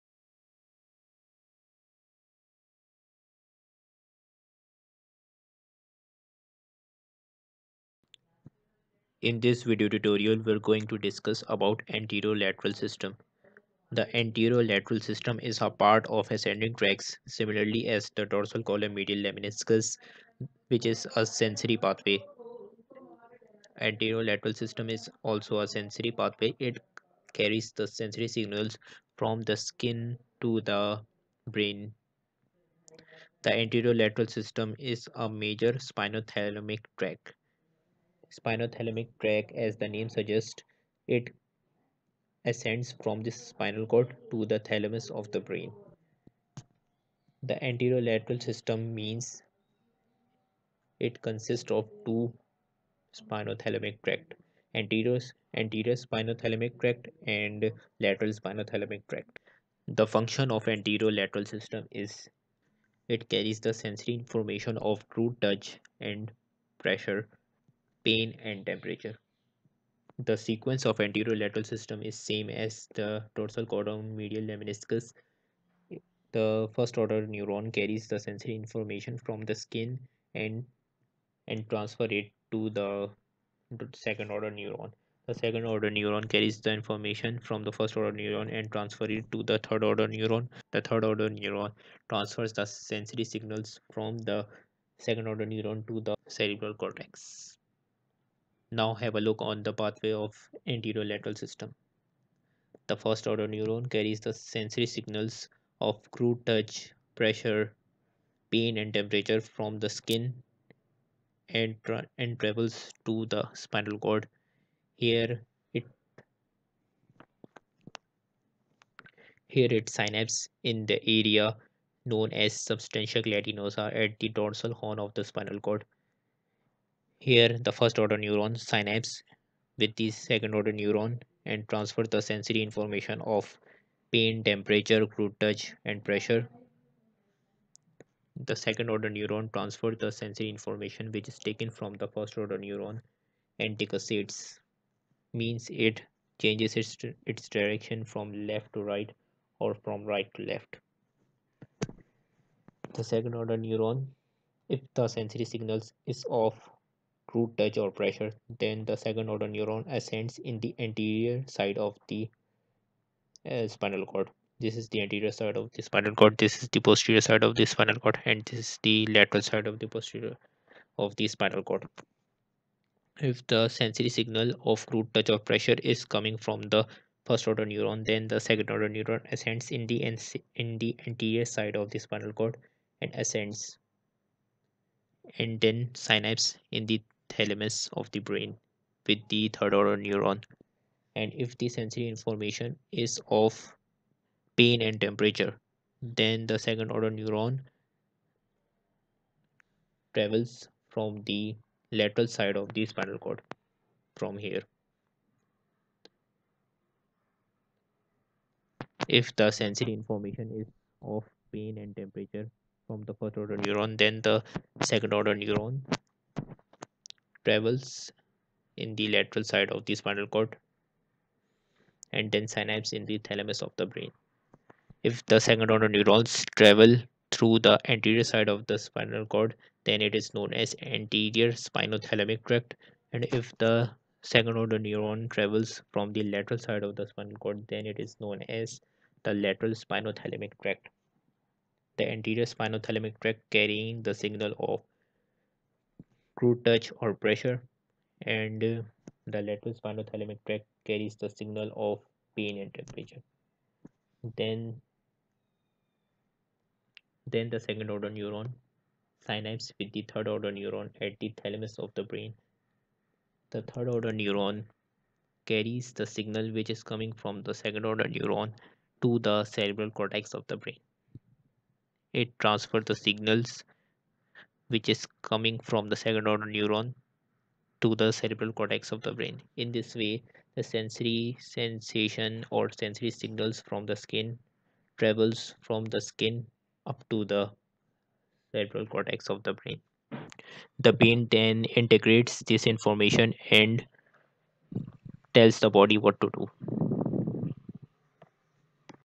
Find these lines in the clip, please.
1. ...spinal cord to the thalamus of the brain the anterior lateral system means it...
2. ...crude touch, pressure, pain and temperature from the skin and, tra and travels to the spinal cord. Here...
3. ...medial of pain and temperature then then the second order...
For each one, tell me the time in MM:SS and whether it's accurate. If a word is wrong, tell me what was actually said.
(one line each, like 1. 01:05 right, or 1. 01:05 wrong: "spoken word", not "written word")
1. 00:43 right
2. 01:46 right
3. 04:11 wrong: "signal", not "medial".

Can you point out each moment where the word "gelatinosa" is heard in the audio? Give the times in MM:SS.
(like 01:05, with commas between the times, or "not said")
02:03.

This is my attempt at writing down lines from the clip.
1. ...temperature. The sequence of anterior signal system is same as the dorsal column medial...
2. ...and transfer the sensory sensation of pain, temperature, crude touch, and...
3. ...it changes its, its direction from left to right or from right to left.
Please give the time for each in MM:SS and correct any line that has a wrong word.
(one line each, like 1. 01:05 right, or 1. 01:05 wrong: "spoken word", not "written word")
1. 01:08 wrong: "lateral", not "signal"
2. 02:11 wrong: "information", not "sensation"
3. 02:25 right.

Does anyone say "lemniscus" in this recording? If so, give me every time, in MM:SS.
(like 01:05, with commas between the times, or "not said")
00:19, 01:14.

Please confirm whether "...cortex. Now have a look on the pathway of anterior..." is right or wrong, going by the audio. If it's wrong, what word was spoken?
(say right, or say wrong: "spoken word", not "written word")
right.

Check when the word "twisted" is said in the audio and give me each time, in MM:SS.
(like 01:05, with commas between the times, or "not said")
not said.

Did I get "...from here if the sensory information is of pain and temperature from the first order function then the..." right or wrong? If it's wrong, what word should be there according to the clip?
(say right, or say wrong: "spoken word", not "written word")
wrong: "neuron", not "function".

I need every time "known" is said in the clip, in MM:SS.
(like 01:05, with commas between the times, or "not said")
02:02, 03:50, 03:58.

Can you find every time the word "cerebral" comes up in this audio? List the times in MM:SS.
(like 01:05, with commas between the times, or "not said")
01:36, 04:29, 04:38, 04:48.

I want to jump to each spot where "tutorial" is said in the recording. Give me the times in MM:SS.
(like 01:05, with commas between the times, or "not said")
00:09.